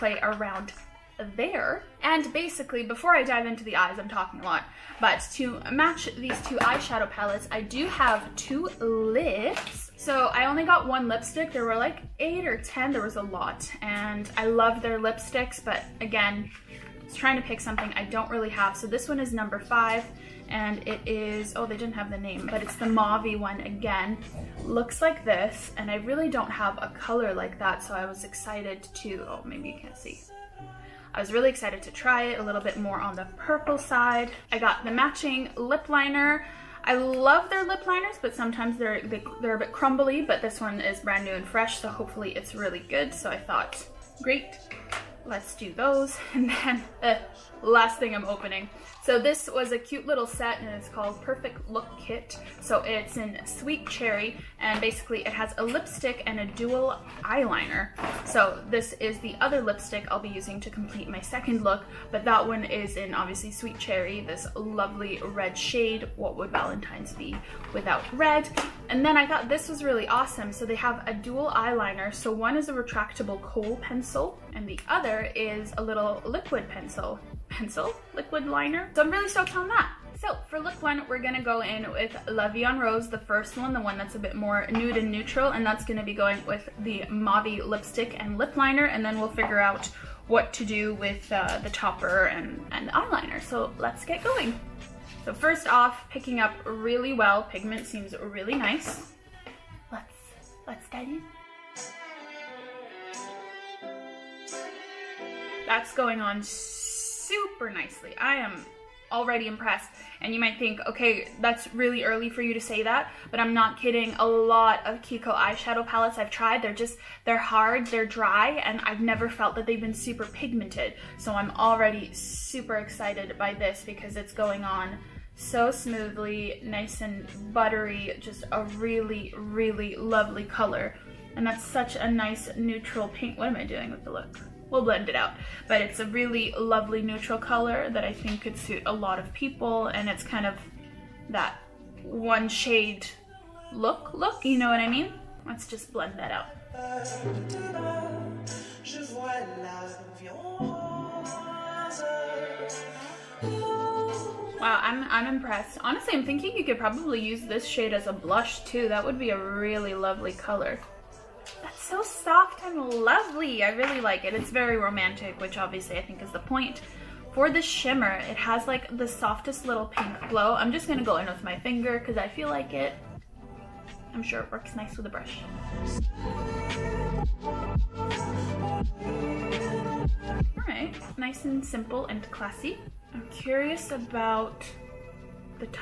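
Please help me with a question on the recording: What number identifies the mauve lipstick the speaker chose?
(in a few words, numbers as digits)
5.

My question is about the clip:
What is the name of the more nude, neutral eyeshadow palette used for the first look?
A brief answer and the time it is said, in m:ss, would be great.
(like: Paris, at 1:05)
La Vie en Rose, at 1:22.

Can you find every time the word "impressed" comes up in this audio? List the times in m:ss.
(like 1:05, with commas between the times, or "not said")
1:49, 2:35.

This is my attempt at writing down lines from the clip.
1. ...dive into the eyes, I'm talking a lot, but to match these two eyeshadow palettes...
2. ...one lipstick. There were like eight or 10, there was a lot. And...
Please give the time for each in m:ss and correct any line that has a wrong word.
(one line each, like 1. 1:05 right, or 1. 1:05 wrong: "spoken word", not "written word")
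1. 0:03 right
2. 0:10 right.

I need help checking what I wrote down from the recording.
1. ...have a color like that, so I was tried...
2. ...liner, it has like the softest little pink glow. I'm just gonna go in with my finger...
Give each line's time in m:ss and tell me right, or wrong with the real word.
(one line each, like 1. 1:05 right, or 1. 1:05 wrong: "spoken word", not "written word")
1. 0:26 wrong: "excited", not "tried"
2. 2:47 wrong: "shimmer", not "liner".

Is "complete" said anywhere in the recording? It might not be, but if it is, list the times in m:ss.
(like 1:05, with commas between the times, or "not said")
1:00.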